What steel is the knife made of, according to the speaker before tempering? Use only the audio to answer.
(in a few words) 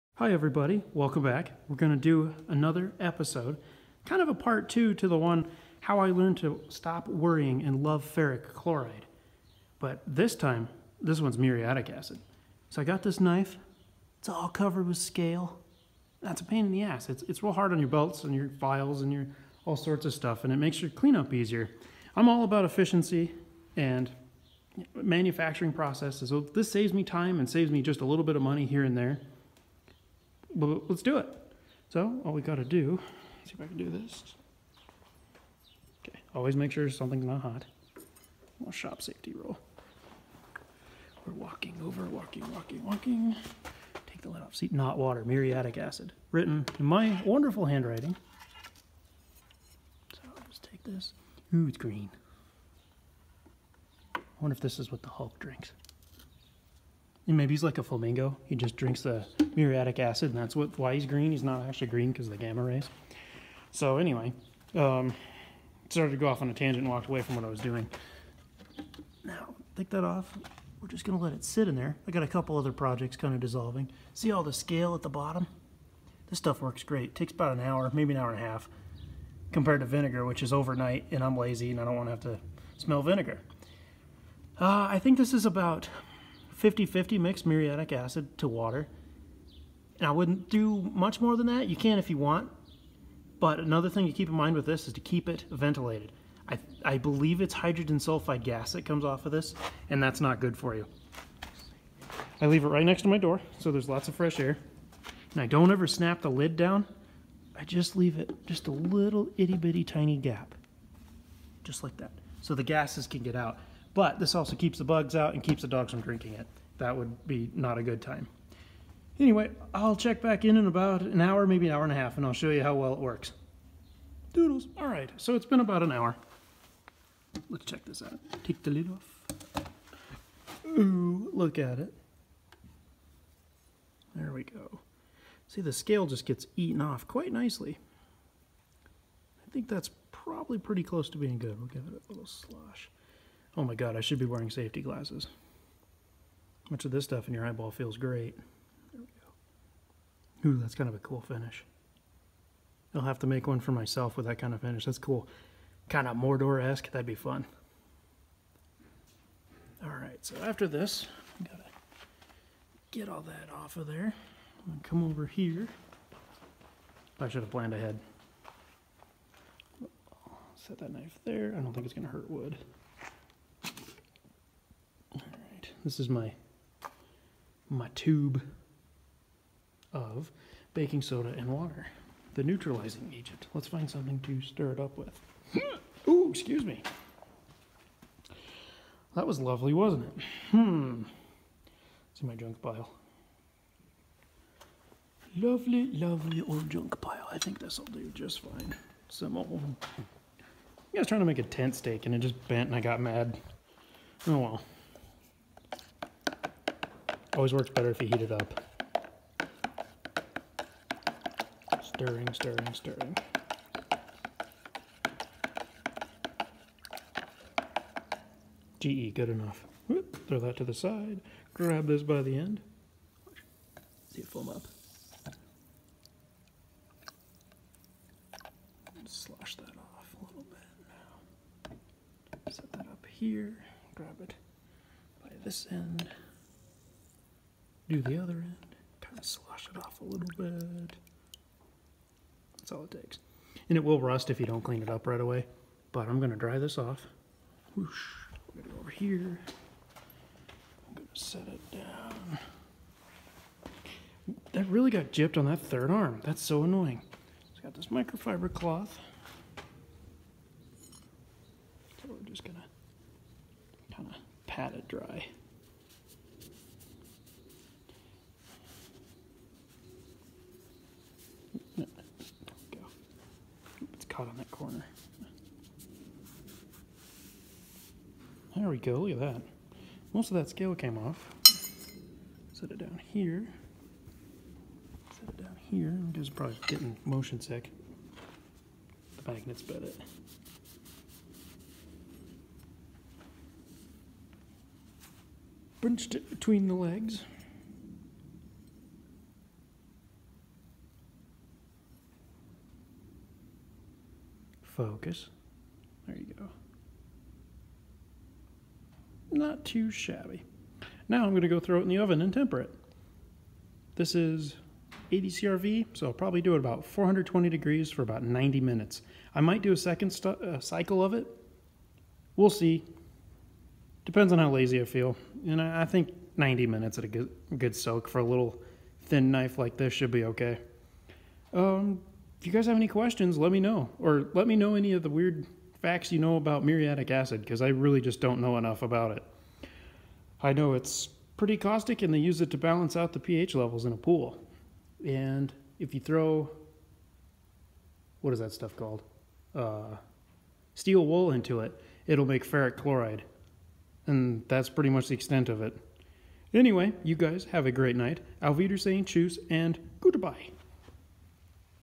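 80CrV.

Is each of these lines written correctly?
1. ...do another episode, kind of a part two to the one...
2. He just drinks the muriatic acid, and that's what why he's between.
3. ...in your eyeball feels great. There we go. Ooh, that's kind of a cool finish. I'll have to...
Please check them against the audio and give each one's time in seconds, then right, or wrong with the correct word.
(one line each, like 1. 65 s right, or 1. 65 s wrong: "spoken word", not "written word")
1. 1 s right
2. 58 s wrong: "green", not "between"
3. 147 s right.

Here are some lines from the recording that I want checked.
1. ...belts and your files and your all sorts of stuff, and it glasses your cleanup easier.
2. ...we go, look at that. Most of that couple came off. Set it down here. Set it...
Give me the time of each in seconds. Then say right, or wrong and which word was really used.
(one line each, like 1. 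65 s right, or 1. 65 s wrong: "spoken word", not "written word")
1. 17 s wrong: "makes", not "glasses"
2. 278 s wrong: "scale", not "couple".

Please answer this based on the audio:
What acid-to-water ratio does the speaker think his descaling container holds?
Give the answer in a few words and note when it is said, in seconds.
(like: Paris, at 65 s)
50-50, at 86 s.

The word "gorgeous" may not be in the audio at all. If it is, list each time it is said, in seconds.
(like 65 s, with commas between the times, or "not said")
not said.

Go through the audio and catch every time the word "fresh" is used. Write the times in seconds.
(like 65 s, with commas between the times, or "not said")
104 s.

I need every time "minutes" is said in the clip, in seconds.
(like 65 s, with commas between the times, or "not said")
318 s, 326 s.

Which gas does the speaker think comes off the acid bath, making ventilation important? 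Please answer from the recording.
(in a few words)
Hydrogen sulfide.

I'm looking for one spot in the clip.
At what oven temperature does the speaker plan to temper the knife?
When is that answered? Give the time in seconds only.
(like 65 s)
316 s.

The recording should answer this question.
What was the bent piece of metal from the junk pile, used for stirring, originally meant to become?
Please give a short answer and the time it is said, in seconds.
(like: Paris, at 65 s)
A tent stake, at 201 s.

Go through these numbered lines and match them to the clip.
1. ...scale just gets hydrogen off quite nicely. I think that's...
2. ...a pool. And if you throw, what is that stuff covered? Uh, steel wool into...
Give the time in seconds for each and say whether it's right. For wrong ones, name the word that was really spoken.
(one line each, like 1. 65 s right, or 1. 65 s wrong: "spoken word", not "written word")
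1. 135 s wrong: "eaten", not "hydrogen"
2. 343 s wrong: "called", not "covered".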